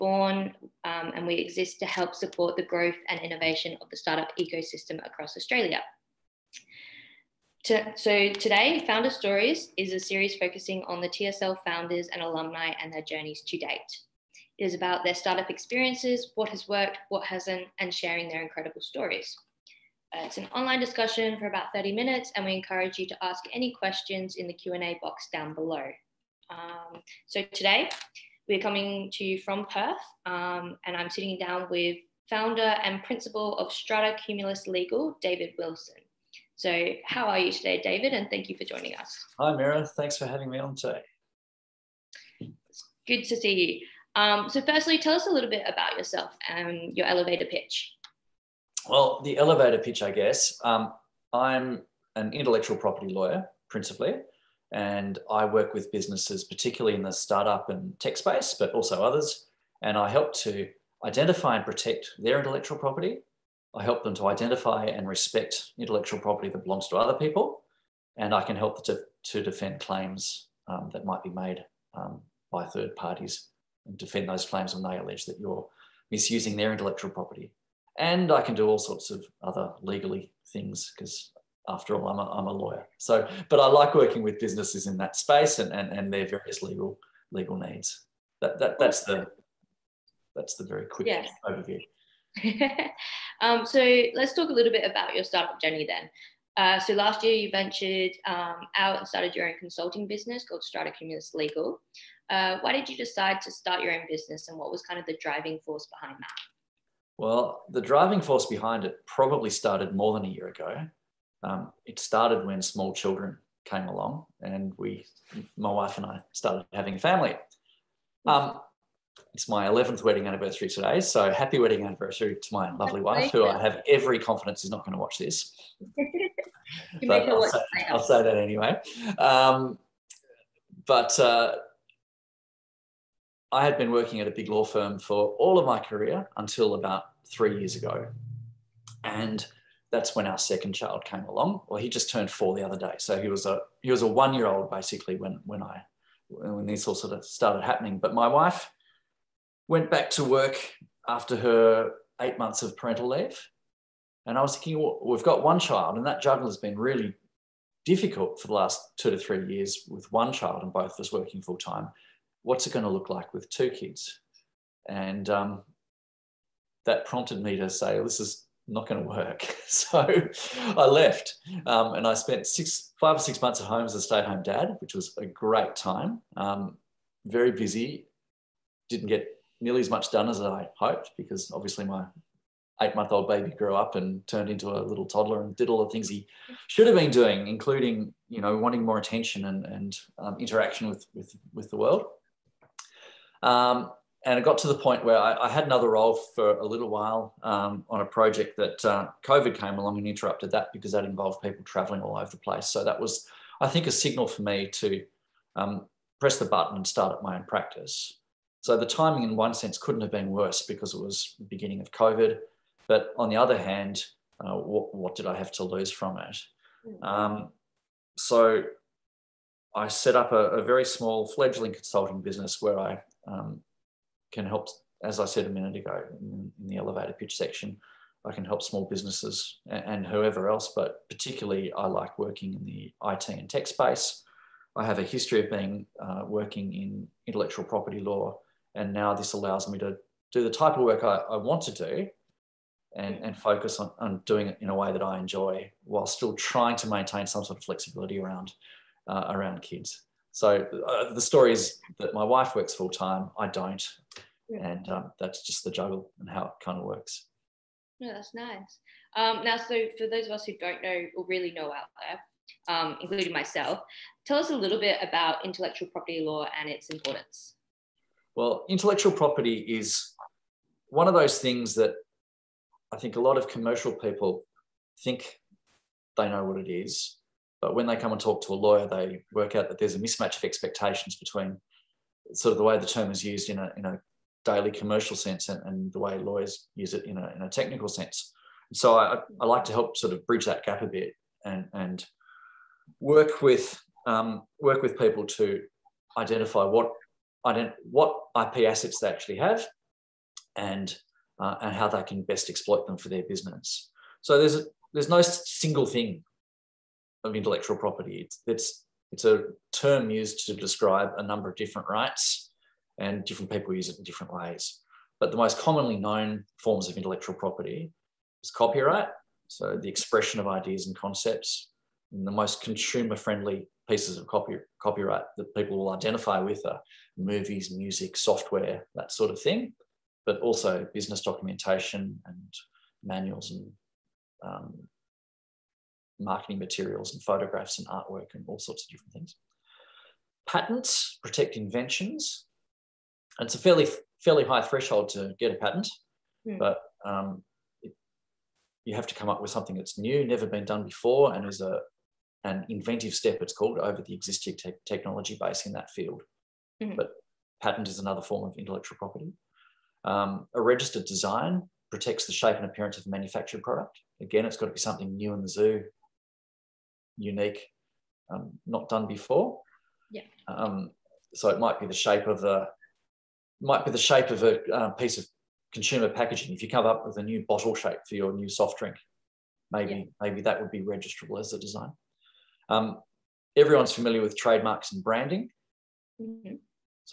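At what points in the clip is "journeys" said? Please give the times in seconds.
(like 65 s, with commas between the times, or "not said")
13 s, 95 s.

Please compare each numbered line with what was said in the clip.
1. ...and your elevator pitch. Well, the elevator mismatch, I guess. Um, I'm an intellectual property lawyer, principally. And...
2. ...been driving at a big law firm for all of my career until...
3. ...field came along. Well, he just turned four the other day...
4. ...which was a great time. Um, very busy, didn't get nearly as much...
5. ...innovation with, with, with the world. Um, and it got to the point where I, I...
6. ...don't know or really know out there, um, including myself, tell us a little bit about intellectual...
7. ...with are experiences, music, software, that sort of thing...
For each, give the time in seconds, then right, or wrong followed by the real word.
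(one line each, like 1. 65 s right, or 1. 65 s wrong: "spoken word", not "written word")
1. 46 s wrong: "pitch", not "mismatch"
2. 133 s wrong: "working", not "driving"
3. 140 s wrong: "child", not "field"
4. 174 s right
5. 190 s wrong: "interaction", not "innovation"
6. 260 s right
7. 326 s wrong: "movies", not "experiences".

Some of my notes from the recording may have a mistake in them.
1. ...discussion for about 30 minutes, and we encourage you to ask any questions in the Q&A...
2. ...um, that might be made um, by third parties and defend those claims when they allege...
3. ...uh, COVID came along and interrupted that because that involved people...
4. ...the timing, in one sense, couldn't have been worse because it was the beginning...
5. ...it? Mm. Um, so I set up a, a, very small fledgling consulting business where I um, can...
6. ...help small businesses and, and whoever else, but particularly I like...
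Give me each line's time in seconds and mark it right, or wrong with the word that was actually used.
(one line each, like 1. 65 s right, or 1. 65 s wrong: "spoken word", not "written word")
1. 20 s right
2. 70 s right
3. 198 s right
4. 208 s right
5. 216 s right
6. 228 s right.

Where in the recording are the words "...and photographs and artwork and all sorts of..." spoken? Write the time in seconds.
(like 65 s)
337 s.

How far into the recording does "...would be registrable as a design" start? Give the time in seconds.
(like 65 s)
380 s.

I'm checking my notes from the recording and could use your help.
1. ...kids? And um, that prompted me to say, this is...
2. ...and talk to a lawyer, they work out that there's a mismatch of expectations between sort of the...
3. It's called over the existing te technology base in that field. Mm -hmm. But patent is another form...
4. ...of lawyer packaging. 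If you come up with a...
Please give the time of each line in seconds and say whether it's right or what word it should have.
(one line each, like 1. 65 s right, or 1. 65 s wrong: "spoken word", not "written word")
1. 163 s right
2. 278 s right
3. 353 s right
4. 375 s wrong: "consumer", not "lawyer".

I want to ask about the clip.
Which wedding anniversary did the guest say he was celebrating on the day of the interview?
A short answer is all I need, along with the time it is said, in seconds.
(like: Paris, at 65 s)
11th, at 119 s.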